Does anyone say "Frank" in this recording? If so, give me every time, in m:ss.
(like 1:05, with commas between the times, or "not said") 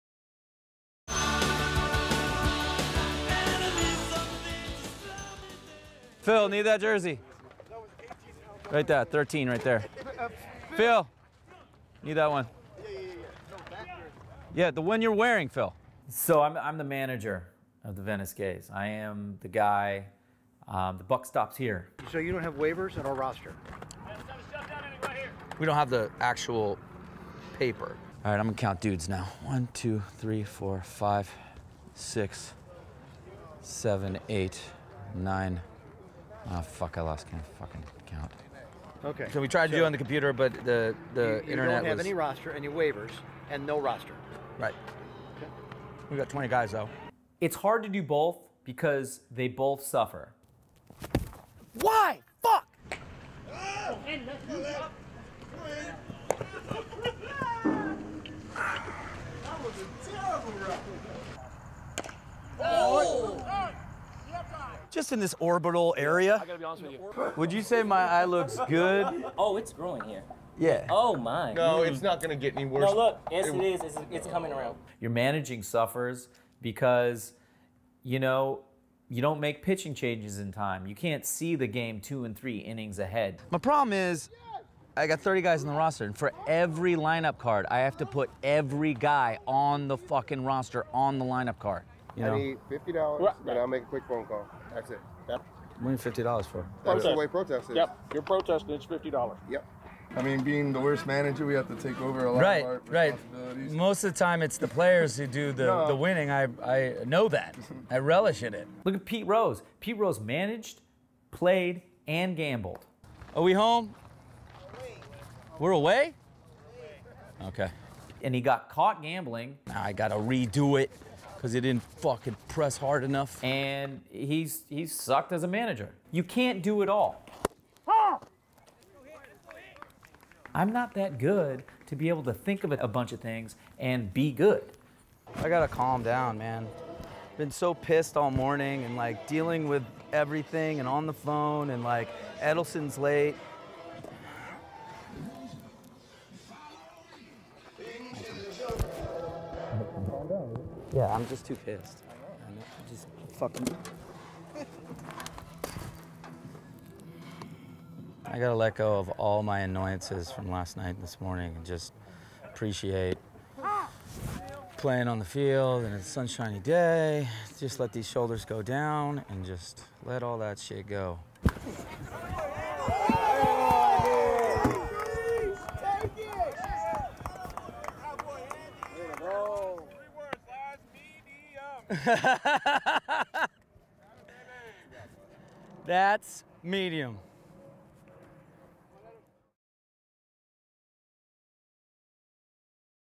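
not said.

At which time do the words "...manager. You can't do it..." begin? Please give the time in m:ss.
2:05.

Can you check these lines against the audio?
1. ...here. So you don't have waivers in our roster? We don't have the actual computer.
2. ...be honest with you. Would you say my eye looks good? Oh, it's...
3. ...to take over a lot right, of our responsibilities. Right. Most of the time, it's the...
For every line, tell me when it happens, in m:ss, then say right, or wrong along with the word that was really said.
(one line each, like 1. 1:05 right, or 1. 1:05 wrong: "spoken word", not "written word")
1. 0:21 wrong: "paper", not "computer"
2. 1:06 right
3. 1:41 right.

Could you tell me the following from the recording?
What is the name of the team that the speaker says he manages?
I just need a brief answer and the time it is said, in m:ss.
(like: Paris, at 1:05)
Venice Gays, at 0:18.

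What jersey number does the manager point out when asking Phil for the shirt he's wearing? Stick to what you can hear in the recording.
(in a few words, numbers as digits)
13.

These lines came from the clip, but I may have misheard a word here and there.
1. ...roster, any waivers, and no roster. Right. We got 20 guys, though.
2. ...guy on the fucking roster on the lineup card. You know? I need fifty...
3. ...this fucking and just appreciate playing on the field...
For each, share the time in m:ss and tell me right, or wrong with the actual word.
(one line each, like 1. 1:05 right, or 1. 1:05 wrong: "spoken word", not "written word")
1. 0:42 right
2. 1:28 right
3. 2:41 wrong: "morning", not "fucking".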